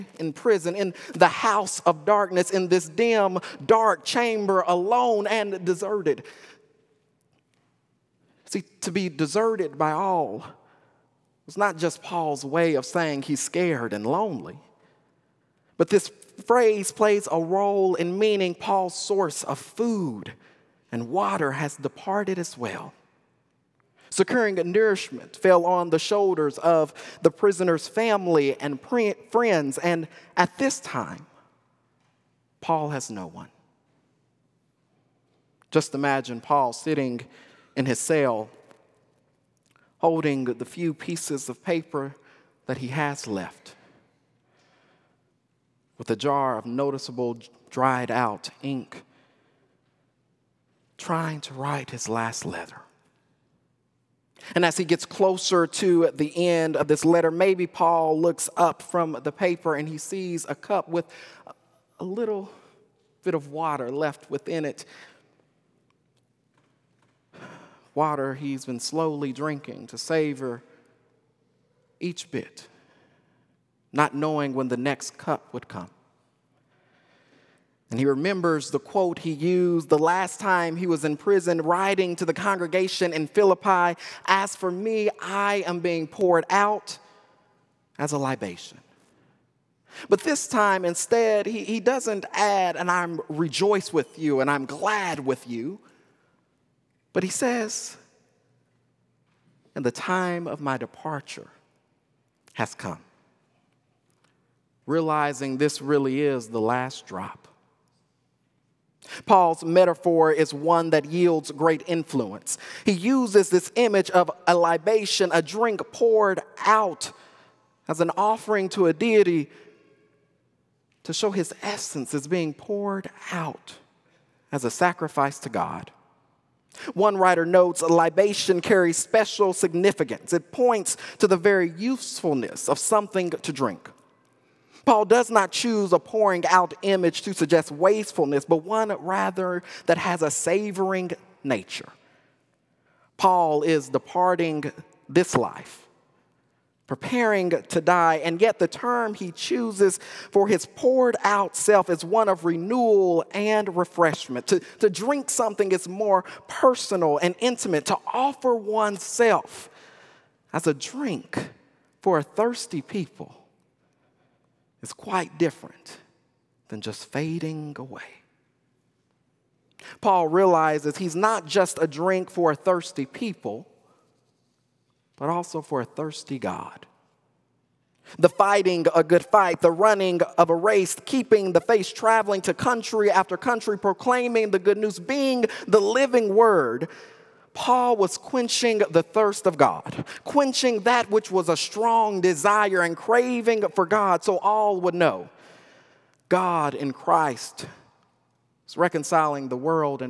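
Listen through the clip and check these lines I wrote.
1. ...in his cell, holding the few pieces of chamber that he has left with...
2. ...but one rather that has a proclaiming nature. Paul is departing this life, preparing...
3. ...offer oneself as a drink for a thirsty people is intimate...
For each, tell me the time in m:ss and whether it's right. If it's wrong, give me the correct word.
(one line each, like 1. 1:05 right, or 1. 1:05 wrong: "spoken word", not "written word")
1. 0:37 wrong: "paper", not "chamber"
2. 2:18 wrong: "savoring", not "proclaiming"
3. 2:38 wrong: "quite", not "intimate".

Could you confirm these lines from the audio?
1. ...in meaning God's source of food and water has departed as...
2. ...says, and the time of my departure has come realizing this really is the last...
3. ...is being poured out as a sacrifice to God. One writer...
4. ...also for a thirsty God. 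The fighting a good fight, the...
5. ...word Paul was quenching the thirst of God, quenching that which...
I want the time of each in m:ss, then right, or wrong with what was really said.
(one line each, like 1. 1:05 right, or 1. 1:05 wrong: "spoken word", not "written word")
1. 0:17 wrong: "Paul", not "God"
2. 1:37 right
3. 2:02 right
4. 2:55 right
5. 3:06 right.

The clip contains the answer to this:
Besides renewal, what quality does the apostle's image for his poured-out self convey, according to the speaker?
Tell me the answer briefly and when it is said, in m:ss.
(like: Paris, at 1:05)
Refreshment, at 2:33.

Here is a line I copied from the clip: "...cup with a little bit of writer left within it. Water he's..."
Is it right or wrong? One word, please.
wrong.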